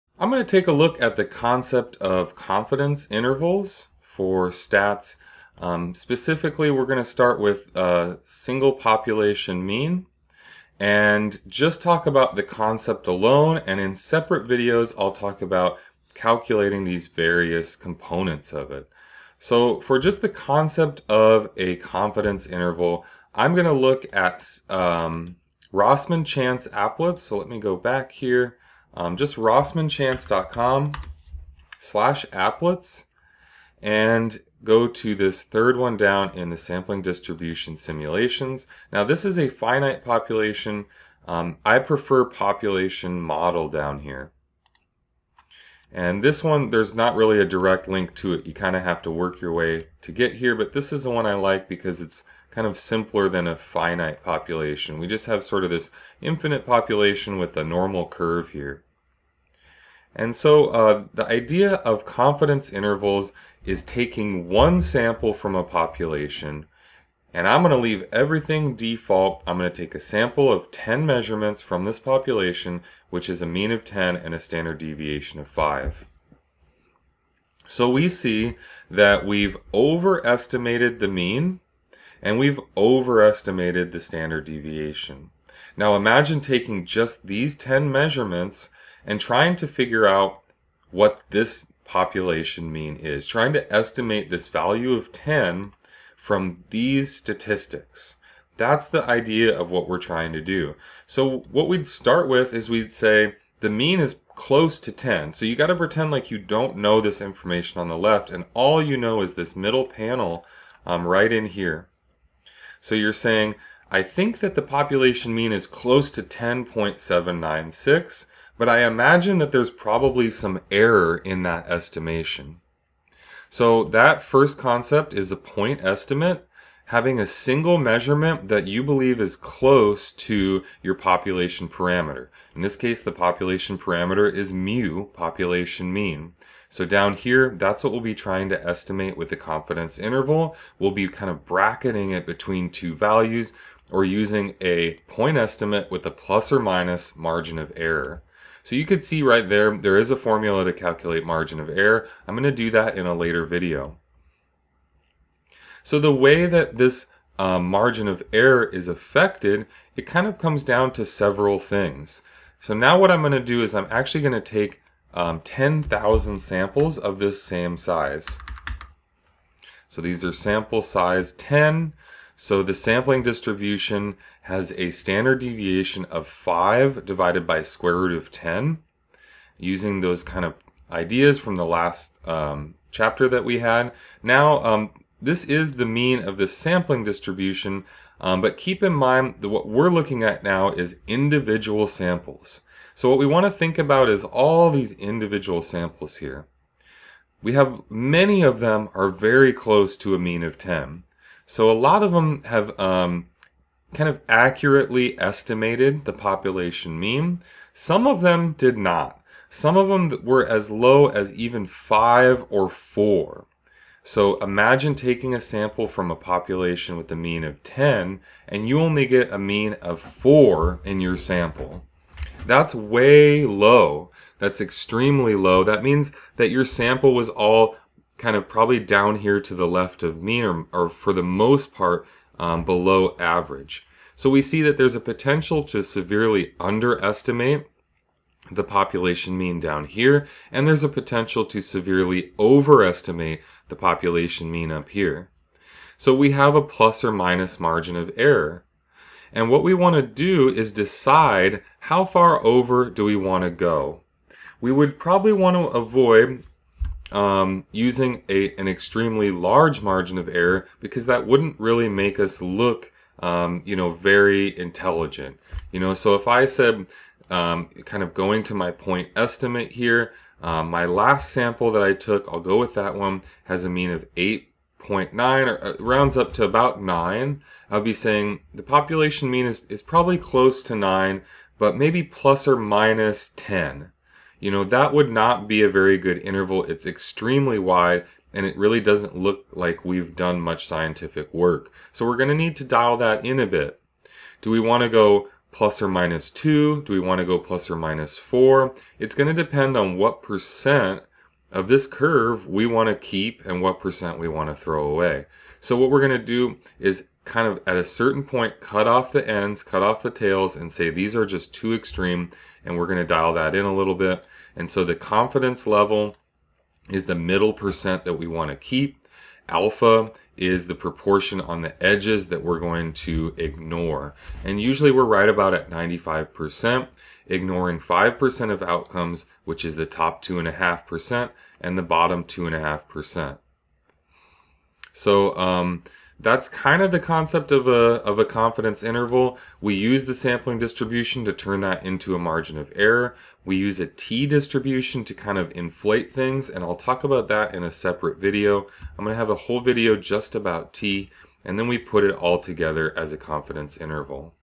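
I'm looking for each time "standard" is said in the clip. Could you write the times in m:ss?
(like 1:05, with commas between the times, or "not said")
1:14, 1:23, 2:54.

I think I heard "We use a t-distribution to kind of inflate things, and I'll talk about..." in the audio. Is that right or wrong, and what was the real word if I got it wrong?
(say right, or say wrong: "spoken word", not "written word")
right.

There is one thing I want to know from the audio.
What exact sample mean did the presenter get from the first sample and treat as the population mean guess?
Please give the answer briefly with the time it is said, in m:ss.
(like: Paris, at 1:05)
10.796, at 1:56.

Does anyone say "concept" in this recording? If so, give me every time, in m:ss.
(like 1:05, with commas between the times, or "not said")
0:01, 0:12, 0:20, 2:04, 5:36.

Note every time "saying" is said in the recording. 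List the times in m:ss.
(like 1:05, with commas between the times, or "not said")
1:53, 4:37.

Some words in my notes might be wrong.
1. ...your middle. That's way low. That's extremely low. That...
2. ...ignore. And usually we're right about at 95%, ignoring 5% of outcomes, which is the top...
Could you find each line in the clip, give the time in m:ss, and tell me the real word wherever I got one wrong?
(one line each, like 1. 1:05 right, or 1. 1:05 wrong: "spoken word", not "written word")
1. 3:41 wrong: "sample", not "middle"
2. 5:23 right.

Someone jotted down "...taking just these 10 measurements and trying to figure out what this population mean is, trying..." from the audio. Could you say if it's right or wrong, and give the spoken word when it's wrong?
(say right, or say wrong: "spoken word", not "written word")
right.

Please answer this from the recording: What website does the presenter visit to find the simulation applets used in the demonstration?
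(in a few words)
rossmanchance.com.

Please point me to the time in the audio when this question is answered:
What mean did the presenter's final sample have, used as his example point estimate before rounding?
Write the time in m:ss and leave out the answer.
4:34.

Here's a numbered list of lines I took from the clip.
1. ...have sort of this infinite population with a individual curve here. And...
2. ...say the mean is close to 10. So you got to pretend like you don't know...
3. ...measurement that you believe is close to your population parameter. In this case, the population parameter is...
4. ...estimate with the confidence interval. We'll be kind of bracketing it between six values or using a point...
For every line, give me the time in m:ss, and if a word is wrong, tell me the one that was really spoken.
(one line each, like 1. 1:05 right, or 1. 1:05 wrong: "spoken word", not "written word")
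1. 0:55 wrong: "normal", not "individual"
2. 1:42 right
3. 2:07 right
4. 2:18 wrong: "two", not "six".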